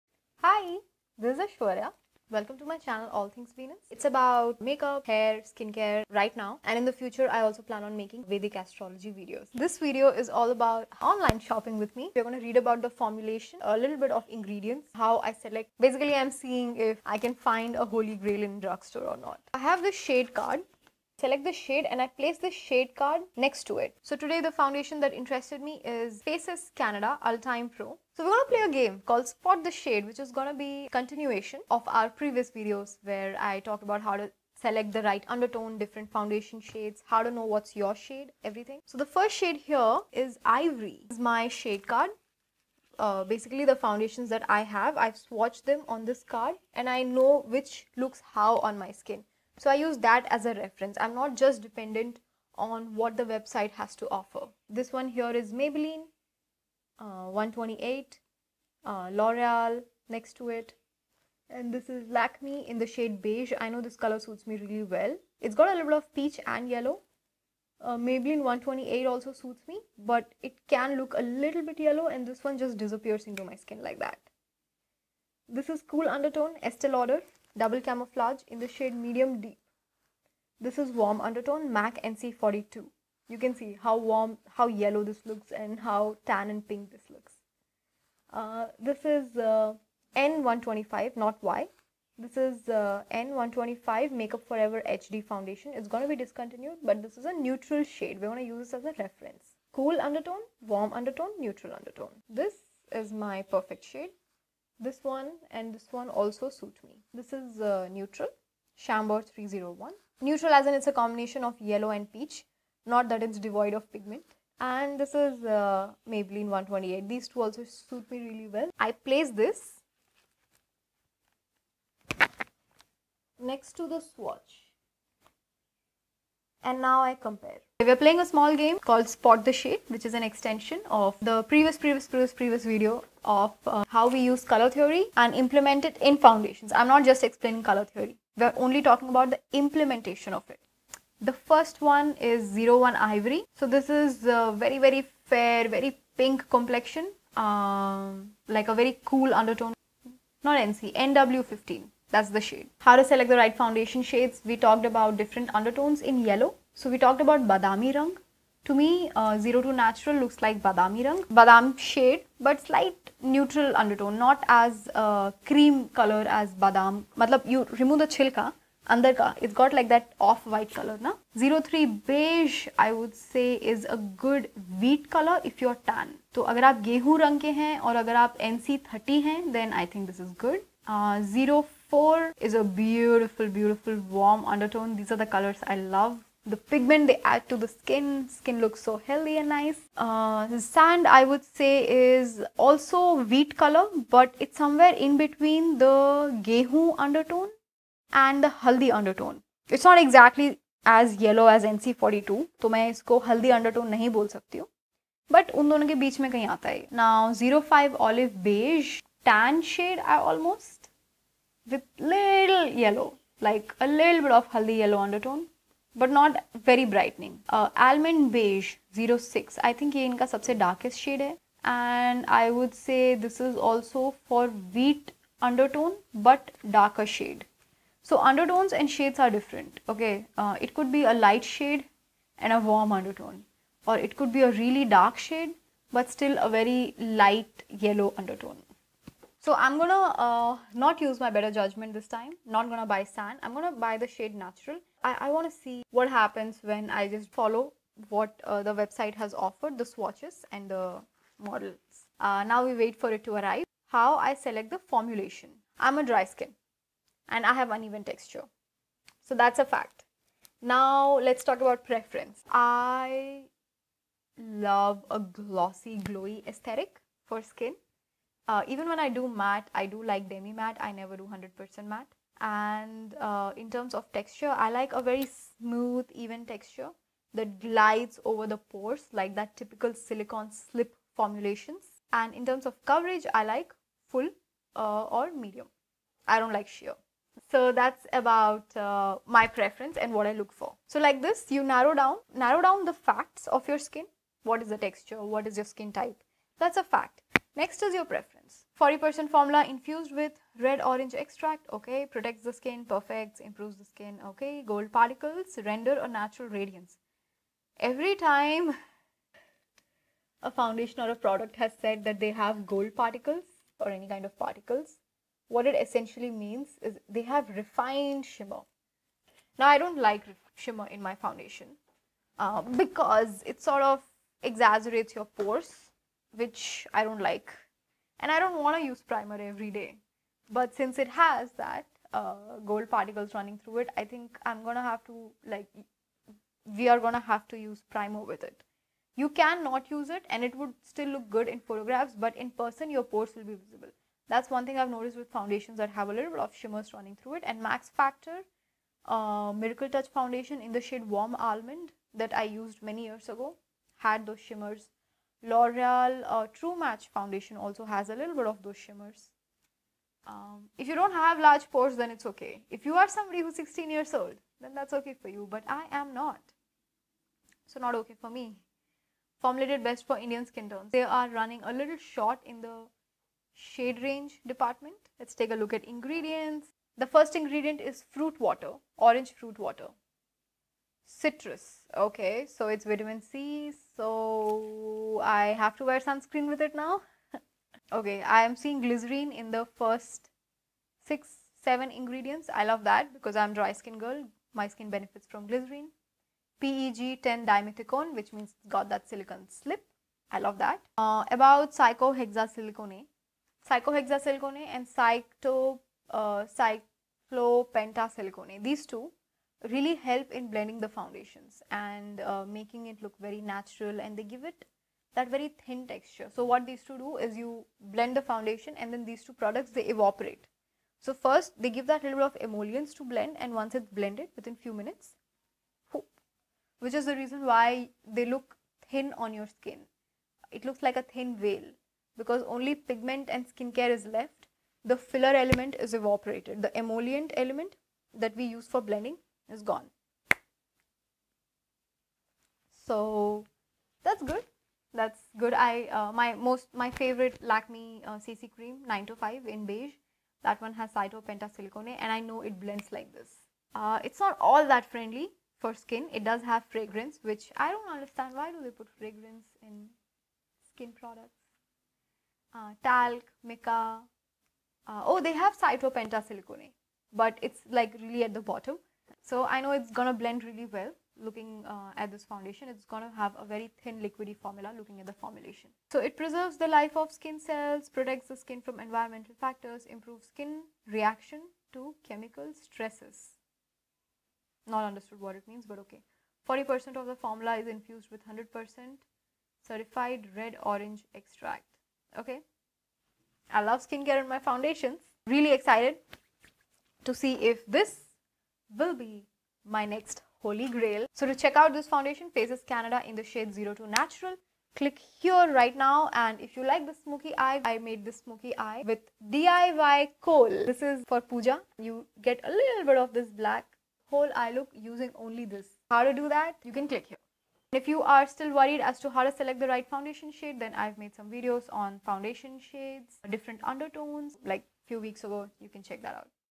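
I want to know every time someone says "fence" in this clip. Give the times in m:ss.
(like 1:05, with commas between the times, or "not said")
not said.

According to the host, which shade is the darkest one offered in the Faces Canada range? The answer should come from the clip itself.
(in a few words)
Almond beige.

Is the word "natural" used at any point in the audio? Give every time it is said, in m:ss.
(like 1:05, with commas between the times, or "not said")
2:39, 4:04, 5:06, 6:53, 8:23.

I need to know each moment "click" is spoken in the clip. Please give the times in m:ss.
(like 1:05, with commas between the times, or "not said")
8:24, 8:36.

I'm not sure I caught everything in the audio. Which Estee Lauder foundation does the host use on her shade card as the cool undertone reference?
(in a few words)
Double camouflage.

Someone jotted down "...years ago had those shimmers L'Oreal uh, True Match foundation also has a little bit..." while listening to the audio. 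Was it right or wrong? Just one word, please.
right.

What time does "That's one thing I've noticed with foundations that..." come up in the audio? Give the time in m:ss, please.
5:44.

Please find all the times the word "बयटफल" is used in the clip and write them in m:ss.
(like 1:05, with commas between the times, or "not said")
3:03.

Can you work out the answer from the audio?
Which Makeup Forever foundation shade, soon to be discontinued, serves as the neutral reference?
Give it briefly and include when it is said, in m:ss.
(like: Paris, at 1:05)
N125, at 1:33.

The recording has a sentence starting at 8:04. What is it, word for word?
Not understood what it means, but okay.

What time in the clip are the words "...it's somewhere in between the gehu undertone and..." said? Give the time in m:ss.
3:14.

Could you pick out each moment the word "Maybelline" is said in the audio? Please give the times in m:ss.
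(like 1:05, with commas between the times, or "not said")
0:55, 1:07, 1:56.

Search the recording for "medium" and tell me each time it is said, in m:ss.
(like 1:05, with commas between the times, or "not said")
1:18, 4:45.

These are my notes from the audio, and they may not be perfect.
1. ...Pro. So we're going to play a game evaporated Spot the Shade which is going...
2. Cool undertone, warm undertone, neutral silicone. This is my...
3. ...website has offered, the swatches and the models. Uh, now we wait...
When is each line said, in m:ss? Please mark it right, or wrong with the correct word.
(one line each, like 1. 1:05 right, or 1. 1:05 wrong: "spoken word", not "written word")
1. 0:27 wrong: "called", not "evaporated"
2. 1:39 wrong: "undertone", not "silicone"
3. 4:08 right.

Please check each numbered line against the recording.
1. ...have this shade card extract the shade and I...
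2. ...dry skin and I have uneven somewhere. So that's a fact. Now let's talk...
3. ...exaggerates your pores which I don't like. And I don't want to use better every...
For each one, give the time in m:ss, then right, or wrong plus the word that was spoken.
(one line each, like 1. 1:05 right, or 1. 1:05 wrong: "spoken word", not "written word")
1. 0:19 wrong: "select", not "extract"
2. 4:16 wrong: "texture", not "somewhere"
3. 5:24 wrong: "primer", not "better".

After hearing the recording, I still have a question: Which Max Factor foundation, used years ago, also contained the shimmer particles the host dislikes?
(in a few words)
Miracle Touch.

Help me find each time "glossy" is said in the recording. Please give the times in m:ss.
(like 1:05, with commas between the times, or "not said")
4:25.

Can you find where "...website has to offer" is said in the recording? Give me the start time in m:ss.
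0:53.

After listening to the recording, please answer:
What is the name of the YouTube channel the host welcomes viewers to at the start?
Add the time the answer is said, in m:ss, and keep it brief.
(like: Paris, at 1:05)
All Things Venus, at 0:03.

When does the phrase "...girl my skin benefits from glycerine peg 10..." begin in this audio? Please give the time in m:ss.
6:34.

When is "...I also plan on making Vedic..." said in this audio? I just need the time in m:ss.
0:07.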